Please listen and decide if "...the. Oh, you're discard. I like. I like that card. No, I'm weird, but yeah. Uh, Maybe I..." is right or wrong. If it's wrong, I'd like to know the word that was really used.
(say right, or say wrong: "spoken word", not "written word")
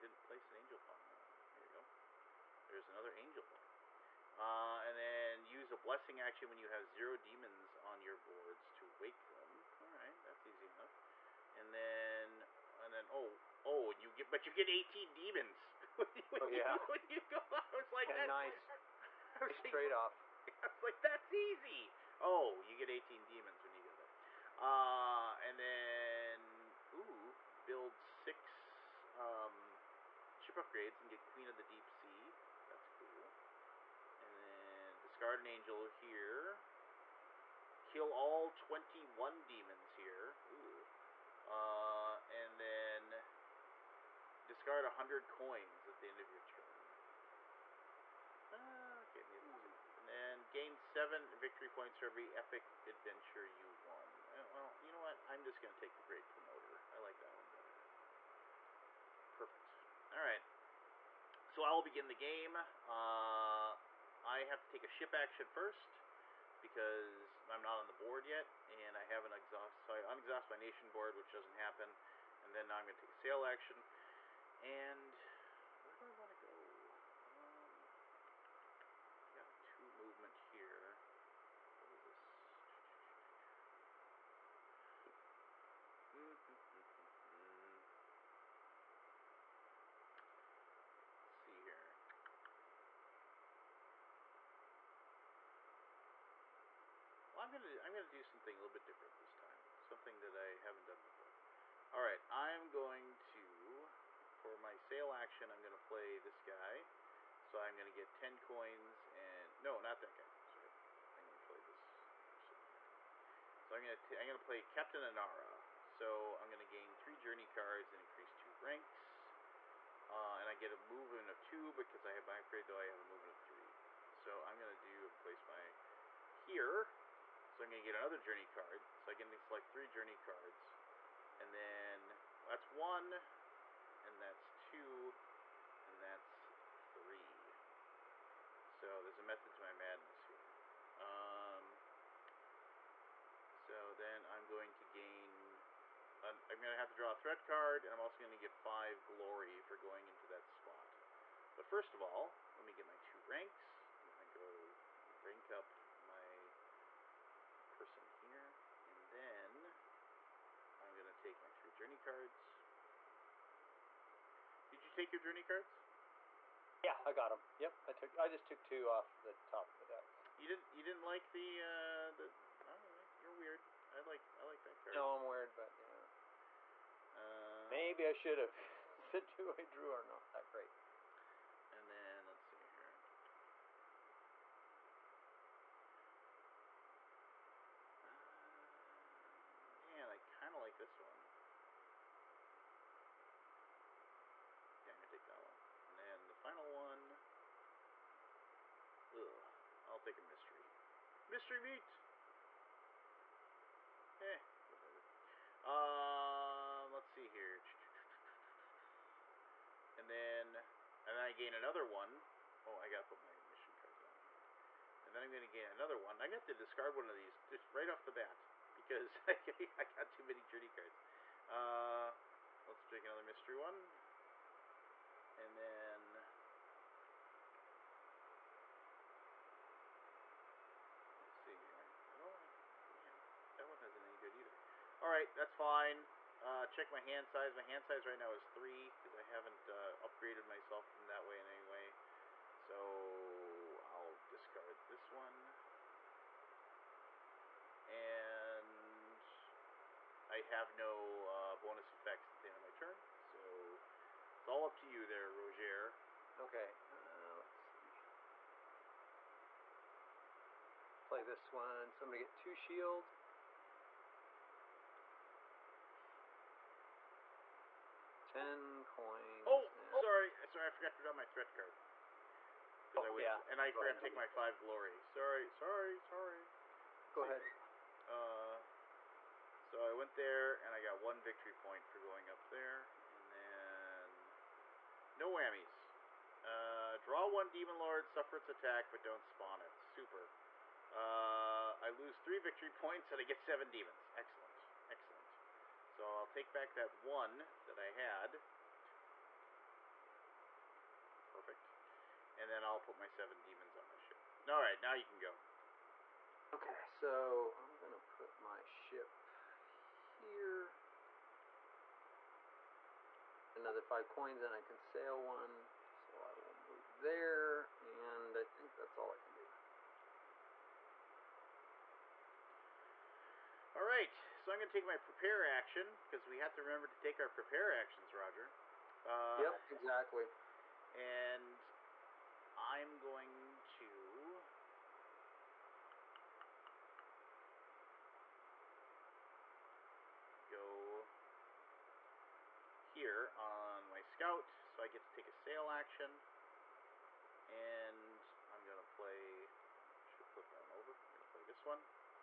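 wrong: "weird", not "discard".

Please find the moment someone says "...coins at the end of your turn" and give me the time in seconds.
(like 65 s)
45 s.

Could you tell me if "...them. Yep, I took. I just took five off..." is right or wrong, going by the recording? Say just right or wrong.
wrong.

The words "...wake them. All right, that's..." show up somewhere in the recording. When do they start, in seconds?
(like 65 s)
9 s.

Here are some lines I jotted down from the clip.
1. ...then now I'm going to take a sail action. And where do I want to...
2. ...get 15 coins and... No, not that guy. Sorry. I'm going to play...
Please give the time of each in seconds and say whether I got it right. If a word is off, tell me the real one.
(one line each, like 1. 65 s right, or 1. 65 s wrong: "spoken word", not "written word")
1. 72 s right
2. 107 s wrong: "10", not "15".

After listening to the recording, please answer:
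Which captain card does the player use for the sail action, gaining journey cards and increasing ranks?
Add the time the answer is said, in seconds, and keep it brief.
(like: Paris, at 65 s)
Captain Anara, at 114 s.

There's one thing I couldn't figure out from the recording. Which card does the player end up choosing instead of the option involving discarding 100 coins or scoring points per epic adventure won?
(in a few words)
Great Promoter.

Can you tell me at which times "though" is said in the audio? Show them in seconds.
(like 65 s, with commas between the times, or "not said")
122 s.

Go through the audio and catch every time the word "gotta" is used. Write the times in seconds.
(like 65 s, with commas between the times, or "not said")
212 s.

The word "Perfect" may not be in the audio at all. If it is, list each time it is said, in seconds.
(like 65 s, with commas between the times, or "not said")
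59 s, 301 s.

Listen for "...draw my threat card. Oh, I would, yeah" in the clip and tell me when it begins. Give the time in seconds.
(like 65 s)
271 s.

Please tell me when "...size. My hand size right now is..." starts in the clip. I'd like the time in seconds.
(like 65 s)
237 s.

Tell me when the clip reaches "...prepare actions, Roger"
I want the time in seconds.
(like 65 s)
327 s.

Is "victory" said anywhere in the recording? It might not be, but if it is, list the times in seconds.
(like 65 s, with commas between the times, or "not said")
51 s, 281 s, 292 s.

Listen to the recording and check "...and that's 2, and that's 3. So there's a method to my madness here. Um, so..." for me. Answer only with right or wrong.
right.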